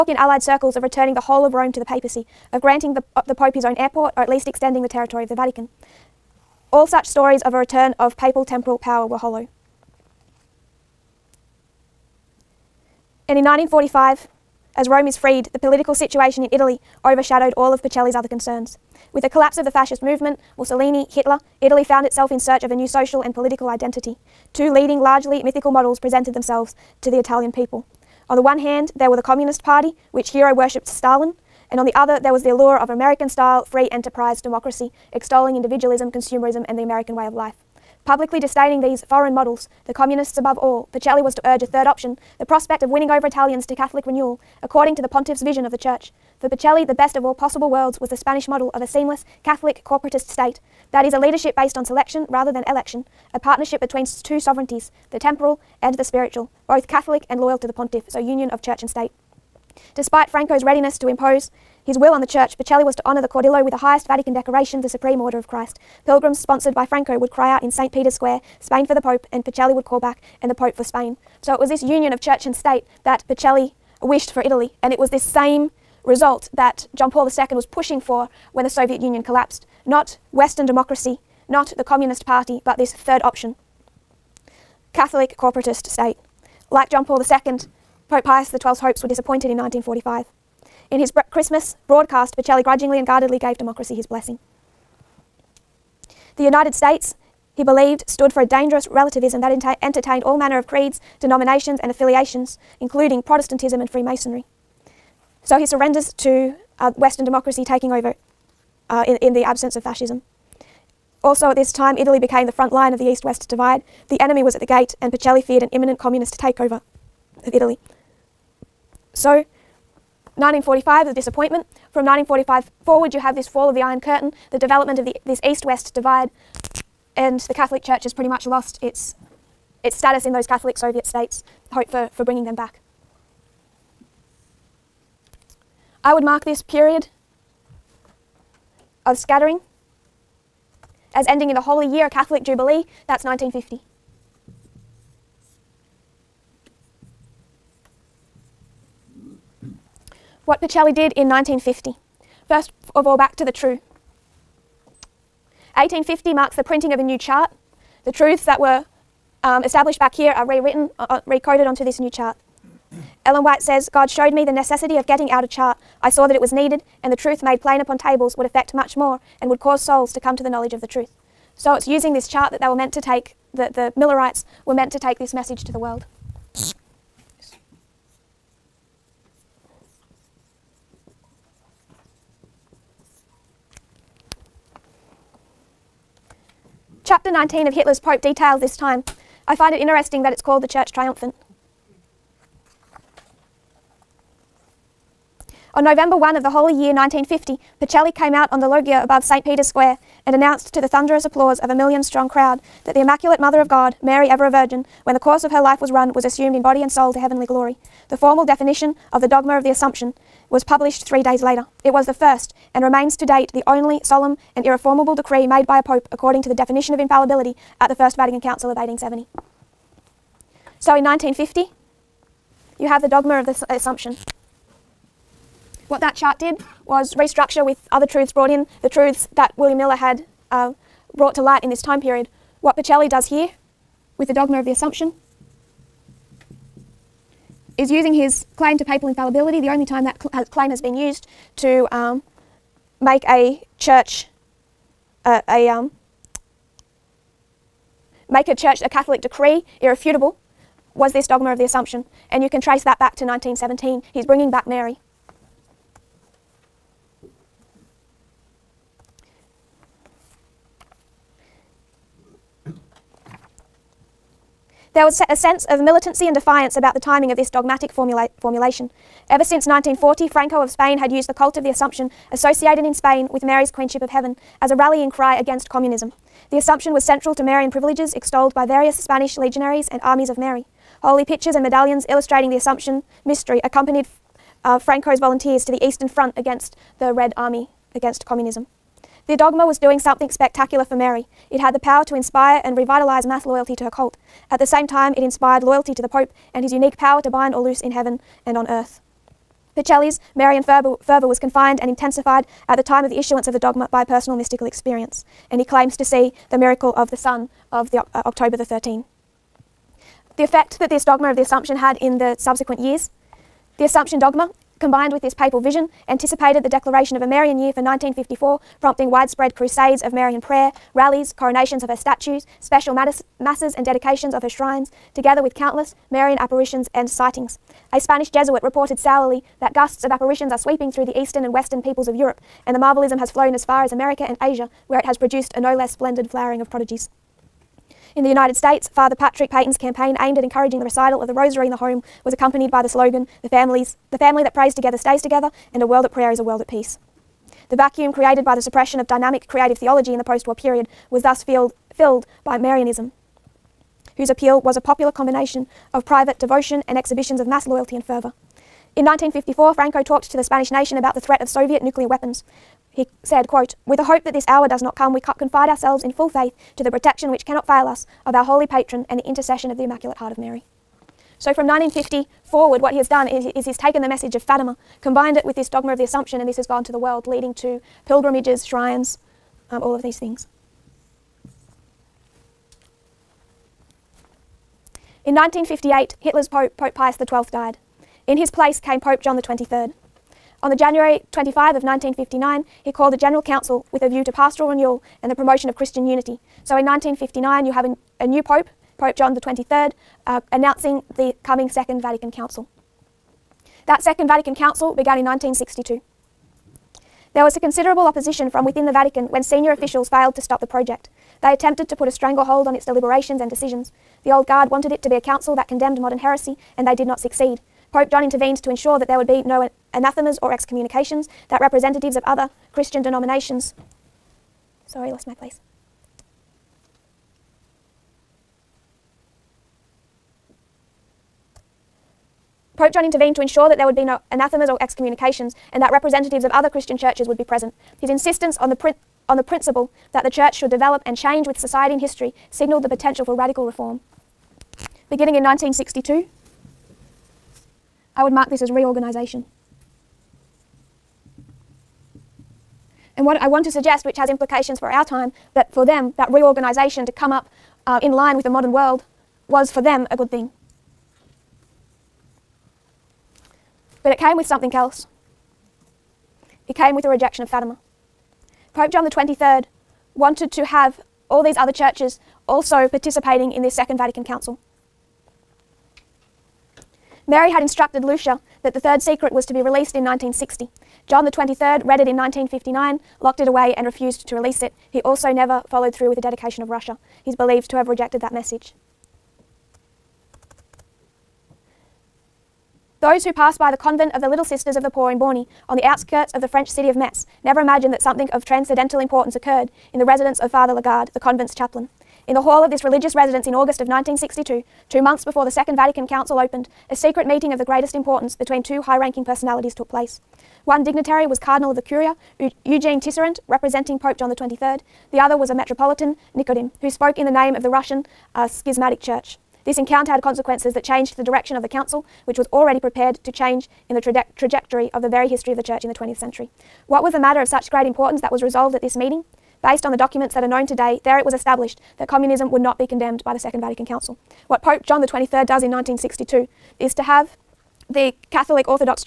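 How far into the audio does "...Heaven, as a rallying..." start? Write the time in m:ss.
4:34.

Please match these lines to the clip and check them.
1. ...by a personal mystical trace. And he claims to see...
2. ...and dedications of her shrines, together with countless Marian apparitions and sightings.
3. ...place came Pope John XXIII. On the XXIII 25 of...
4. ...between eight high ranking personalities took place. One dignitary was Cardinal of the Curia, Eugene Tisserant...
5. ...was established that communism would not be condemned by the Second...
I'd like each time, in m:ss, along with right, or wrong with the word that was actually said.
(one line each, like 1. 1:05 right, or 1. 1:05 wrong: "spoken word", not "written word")
1. 5:03 wrong: "experience", not "trace"
2. 5:23 right
3. 6:28 wrong: "January", not "XXIII"
4. 8:28 wrong: "two", not "eight"
5. 8:51 right.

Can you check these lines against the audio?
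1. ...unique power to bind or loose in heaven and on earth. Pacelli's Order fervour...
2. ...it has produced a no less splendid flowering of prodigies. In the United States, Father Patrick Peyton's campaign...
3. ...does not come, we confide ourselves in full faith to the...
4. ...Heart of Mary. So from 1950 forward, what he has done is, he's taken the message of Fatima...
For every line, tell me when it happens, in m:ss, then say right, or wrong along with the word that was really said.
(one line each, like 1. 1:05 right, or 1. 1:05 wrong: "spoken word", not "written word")
1. 4:56 wrong: "Marian", not "Order"
2. 5:34 right
3. 6:04 right
4. 6:10 right.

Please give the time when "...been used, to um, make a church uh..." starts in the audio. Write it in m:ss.
4:00.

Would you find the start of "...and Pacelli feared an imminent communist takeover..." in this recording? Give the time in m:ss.
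1:55.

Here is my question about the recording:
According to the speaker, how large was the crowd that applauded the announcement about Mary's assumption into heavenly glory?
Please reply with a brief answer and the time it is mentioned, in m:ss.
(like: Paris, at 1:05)
a million, at 3:21.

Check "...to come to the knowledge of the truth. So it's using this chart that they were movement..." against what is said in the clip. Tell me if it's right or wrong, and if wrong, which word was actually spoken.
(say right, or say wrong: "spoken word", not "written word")
wrong: "meant", not "movement".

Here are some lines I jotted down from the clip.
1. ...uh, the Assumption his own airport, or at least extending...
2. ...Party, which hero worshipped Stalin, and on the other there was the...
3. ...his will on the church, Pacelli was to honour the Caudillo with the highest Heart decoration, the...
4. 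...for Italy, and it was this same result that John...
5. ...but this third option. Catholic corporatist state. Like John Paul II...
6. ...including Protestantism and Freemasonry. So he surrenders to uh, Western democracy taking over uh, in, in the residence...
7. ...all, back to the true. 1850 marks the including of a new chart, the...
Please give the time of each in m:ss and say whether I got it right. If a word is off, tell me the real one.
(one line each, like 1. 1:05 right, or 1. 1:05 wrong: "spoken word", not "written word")
1. 0:03 wrong: "Pope", not "Assumption"
2. 0:29 right
3. 1:01 wrong: "Vatican", not "Heart"
4. 1:14 right
5. 1:22 right
6. 1:42 wrong: "absence", not "residence"
7. 2:33 wrong: "printing", not "including".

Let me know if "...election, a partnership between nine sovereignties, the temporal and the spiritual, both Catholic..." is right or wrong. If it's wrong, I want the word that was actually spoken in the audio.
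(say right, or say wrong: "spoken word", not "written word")
wrong: "two", not "nine".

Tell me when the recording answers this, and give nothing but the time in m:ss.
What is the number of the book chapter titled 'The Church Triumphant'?
3:07.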